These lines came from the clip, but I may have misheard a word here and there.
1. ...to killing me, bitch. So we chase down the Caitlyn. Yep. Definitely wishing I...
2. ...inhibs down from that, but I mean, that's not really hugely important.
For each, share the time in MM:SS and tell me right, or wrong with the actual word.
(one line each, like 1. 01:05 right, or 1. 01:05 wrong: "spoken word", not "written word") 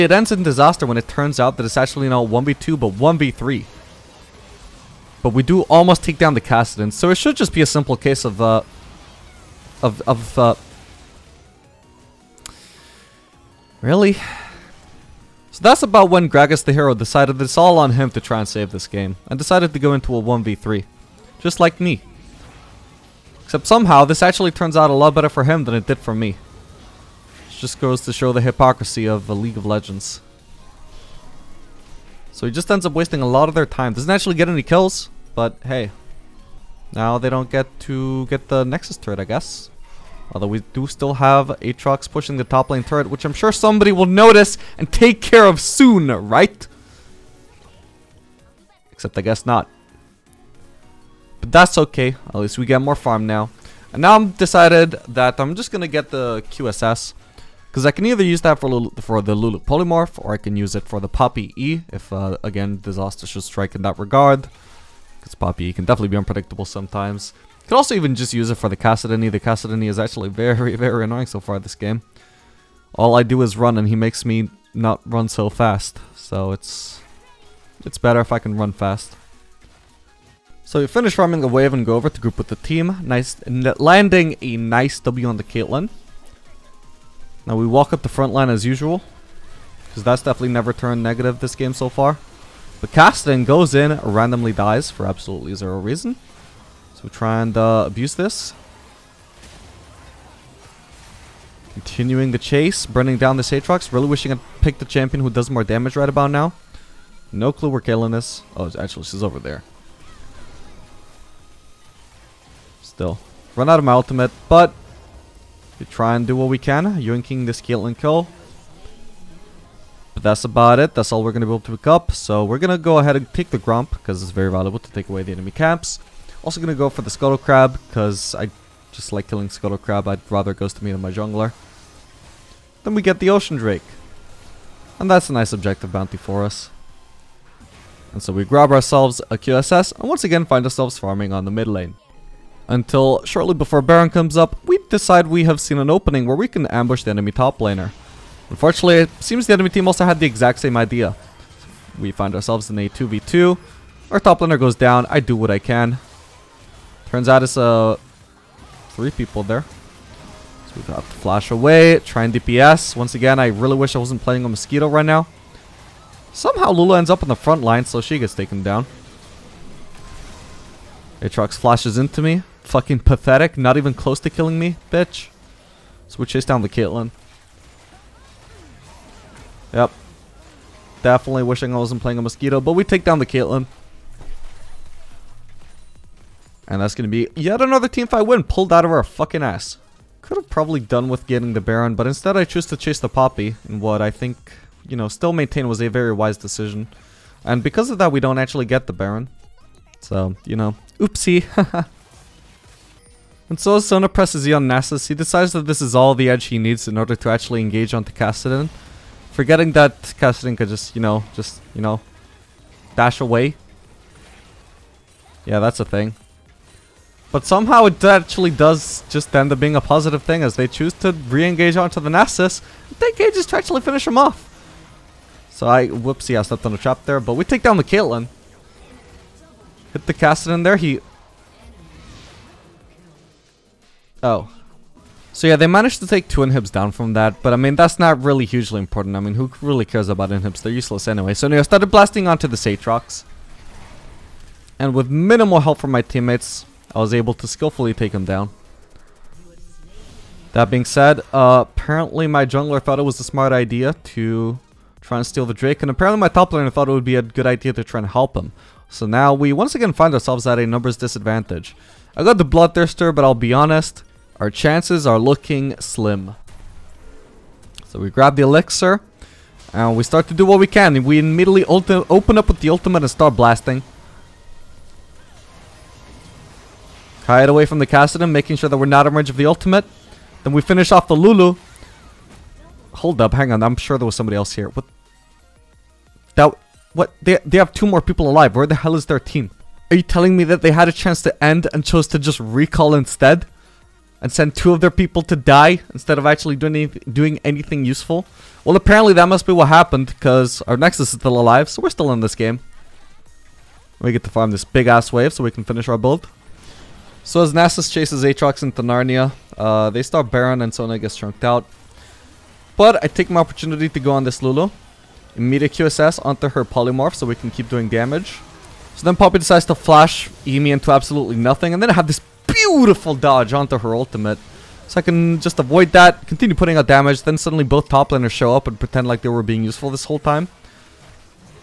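1. 02:54 right
2. 03:56 right.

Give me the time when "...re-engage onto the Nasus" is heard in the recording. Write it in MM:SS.
03:41.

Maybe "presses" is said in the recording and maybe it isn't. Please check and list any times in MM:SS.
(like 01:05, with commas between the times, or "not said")
03:24.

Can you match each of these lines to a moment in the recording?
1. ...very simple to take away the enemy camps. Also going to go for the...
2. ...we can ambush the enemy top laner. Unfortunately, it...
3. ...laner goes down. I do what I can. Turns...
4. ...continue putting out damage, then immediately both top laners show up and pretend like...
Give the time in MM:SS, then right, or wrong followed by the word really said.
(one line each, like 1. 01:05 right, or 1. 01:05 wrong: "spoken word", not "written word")
1. 02:04 wrong: "valuable", not "simple"
2. 02:26 right
3. 02:34 right
4. 05:26 wrong: "suddenly", not "immediately".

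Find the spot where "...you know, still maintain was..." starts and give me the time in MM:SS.
03:14.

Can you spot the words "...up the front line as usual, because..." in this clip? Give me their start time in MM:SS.
01:27.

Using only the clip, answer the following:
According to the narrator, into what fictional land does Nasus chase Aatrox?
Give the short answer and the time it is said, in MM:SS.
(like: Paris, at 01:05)
Narnia, at 05:08.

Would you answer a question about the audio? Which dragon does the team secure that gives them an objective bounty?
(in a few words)
Ocean Drake.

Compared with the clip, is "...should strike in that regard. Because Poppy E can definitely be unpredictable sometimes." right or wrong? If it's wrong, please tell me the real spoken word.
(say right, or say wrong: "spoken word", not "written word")
right.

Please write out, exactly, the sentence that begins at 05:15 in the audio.
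Immediate QSS onto her Polymorph so we can keep doing damage.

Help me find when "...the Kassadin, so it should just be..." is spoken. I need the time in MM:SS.
00:06.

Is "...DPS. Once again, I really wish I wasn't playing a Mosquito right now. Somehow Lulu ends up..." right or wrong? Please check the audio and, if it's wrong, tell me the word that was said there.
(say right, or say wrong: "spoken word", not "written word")
right.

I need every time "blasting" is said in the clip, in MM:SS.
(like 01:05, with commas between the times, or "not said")
04:01, 04:33.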